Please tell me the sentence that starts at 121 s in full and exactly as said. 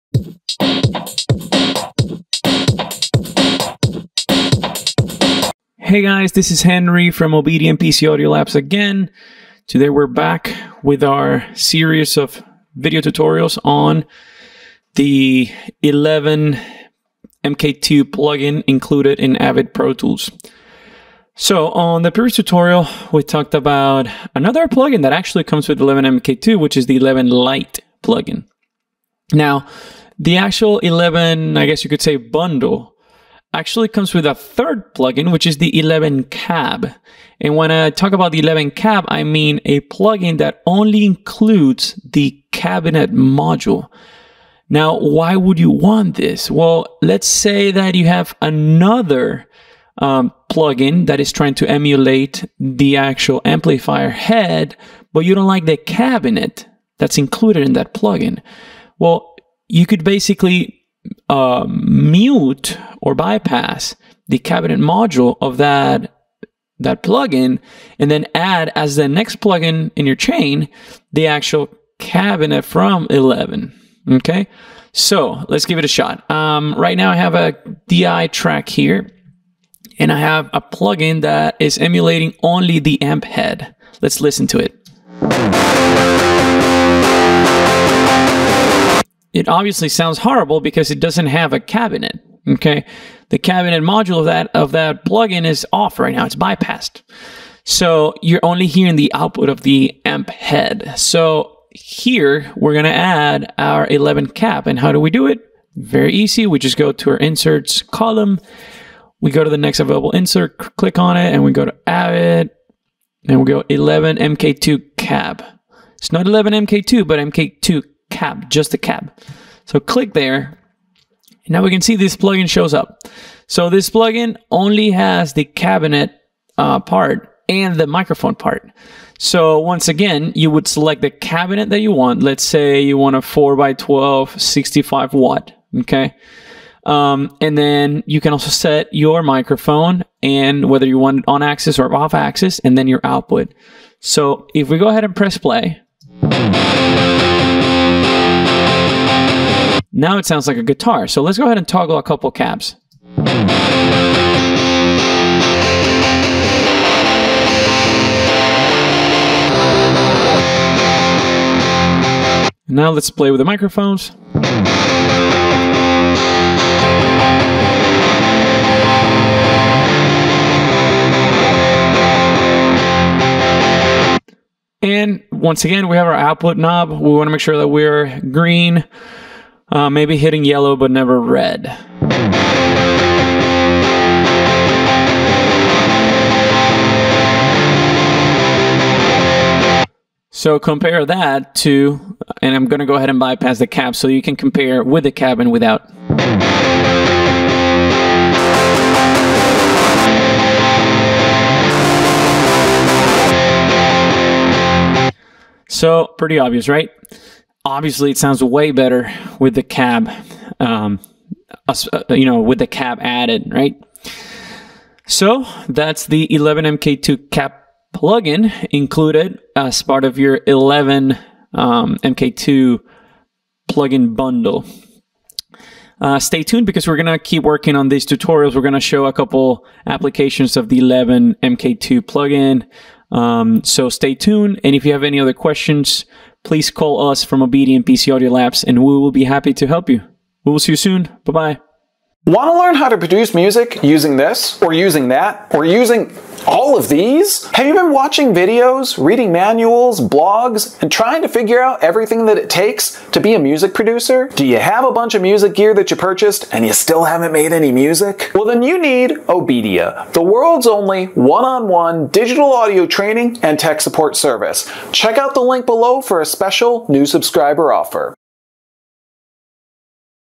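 now we can see this plugin shows up.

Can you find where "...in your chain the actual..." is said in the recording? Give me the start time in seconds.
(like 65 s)
69 s.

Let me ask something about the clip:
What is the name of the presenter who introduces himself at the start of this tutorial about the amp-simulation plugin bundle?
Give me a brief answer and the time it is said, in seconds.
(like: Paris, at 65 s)
Henry, at 6 s.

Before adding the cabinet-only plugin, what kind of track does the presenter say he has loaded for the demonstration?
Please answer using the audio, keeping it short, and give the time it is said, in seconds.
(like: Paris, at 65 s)
DI track, at 77 s.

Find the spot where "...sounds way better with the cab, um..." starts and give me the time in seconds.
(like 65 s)
208 s.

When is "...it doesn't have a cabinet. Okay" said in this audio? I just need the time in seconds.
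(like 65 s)
90 s.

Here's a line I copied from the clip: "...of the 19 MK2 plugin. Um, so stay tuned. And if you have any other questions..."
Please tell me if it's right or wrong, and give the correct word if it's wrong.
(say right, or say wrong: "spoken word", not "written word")
wrong: "11", not "19".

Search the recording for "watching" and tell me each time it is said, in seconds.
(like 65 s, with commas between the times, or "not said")
247 s.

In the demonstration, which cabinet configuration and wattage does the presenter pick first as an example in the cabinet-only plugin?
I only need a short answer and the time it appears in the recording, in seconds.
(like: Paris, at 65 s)
4x12 65 watt, at 133 s.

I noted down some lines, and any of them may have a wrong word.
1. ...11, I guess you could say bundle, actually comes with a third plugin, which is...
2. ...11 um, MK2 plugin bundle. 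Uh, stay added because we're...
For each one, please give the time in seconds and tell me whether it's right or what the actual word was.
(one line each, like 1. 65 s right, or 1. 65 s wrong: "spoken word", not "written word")
1. 30 s right
2. 220 s wrong: "tuned", not "added".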